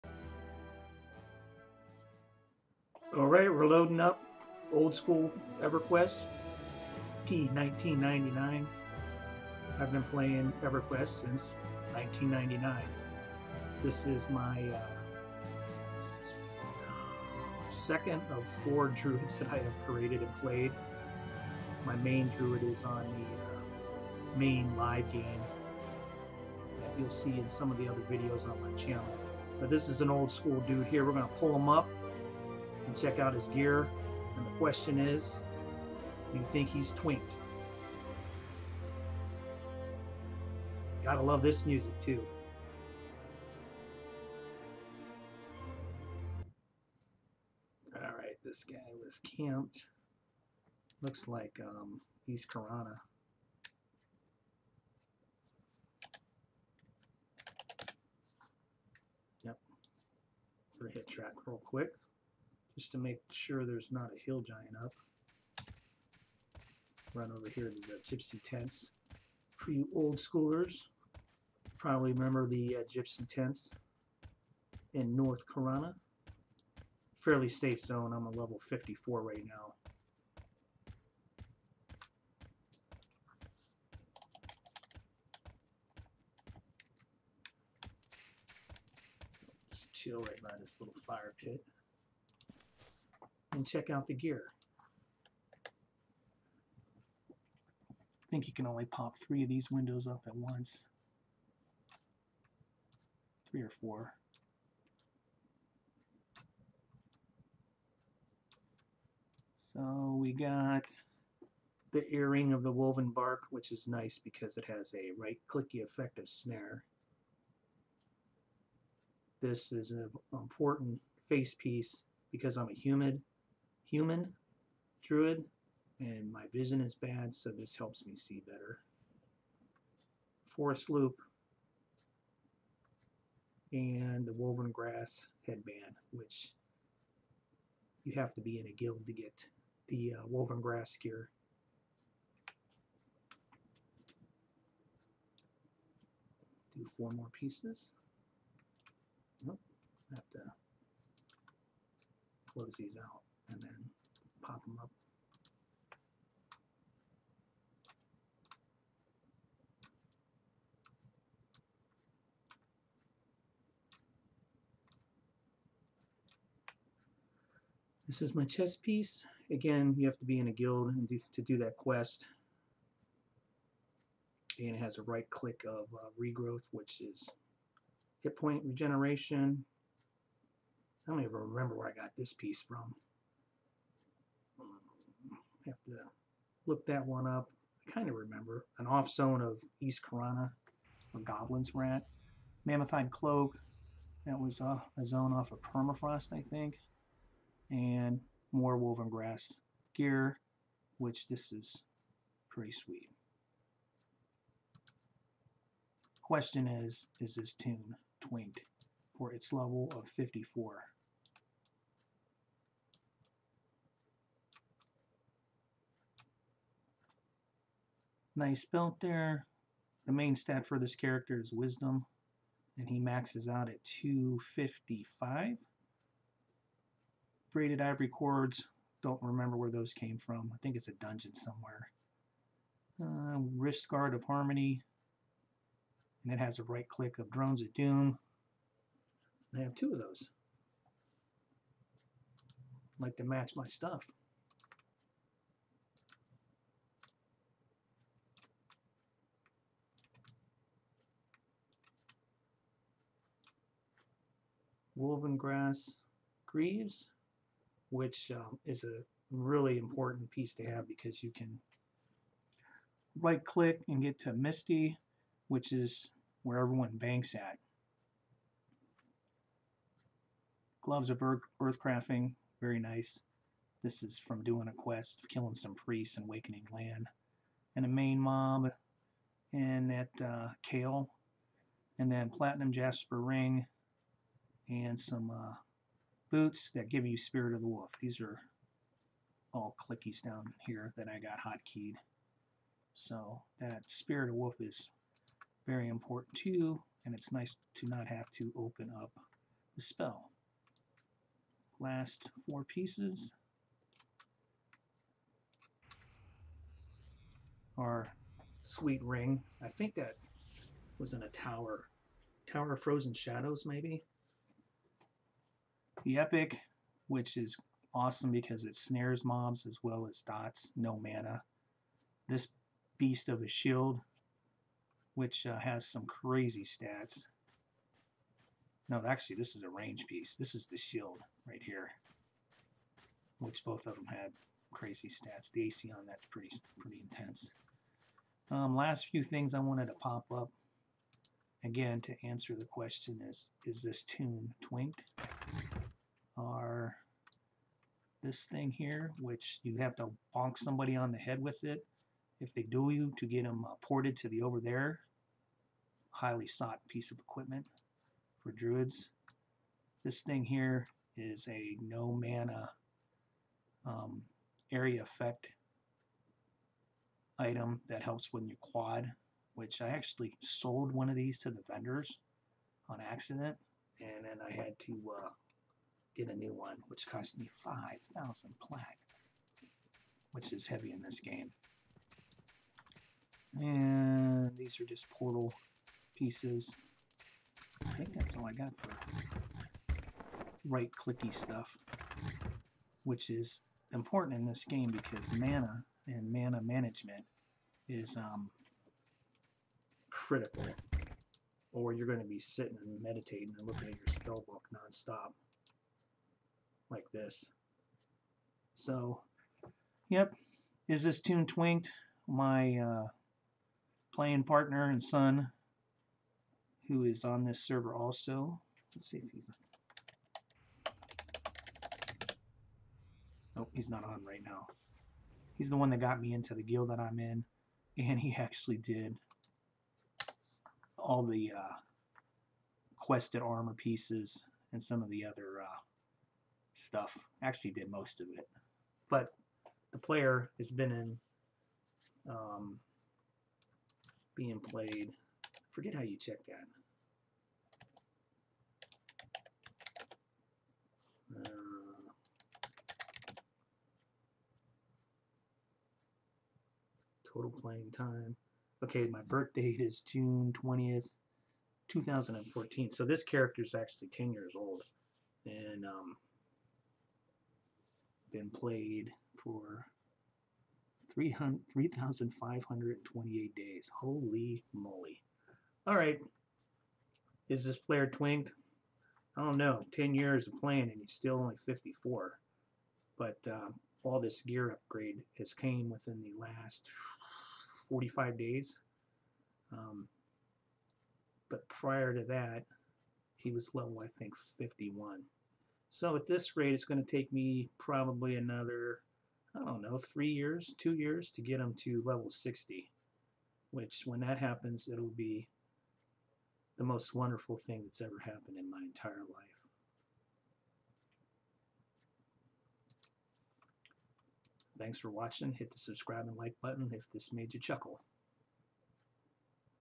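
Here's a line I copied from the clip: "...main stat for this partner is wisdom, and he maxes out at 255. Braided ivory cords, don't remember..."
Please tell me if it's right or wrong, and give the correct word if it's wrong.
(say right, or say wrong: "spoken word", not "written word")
wrong: "character", not "partner".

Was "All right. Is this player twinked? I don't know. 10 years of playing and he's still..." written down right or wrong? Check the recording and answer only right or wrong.
right.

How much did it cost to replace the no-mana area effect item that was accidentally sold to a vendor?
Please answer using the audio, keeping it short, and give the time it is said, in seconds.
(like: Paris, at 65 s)
5,000 plat, at 377 s.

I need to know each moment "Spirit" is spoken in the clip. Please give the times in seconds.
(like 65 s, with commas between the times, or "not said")
287 s, 293 s.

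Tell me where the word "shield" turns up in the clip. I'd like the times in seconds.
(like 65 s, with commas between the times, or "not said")
323 s, 330 s.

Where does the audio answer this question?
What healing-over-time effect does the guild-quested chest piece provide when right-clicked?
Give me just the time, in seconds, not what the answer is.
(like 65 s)
176 s.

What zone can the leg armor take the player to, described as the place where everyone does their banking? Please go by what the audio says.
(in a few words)
Misty.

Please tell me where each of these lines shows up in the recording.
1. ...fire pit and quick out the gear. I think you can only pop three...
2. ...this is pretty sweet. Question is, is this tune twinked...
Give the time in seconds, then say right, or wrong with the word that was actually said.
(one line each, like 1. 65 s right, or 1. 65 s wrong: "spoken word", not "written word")
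1. 91 s wrong: "check", not "quick"
2. 201 s right.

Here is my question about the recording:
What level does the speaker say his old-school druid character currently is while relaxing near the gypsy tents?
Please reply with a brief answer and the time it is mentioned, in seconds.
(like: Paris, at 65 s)
54, at 78 s.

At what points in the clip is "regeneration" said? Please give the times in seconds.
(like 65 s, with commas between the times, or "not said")
178 s.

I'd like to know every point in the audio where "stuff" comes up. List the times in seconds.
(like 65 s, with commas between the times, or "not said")
243 s, 391 s, 436 s.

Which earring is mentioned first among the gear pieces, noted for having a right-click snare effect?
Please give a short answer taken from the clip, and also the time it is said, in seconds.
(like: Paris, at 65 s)
Earring of the Woven Bark, at 112 s.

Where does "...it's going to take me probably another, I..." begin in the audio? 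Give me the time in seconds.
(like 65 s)
496 s.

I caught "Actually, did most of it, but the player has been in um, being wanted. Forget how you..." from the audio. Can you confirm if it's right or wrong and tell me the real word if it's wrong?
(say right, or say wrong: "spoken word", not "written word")
wrong: "played", not "wanted".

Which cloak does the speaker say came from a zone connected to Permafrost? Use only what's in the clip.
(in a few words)
Mammothide Cloak.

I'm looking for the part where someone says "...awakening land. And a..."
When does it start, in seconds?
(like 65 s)
276 s.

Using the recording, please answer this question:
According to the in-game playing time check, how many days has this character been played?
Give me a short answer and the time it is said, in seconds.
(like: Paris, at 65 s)
3,528, at 471 s.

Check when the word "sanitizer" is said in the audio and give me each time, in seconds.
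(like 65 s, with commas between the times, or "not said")
not said.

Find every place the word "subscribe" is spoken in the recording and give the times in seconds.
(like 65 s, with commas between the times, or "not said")
515 s.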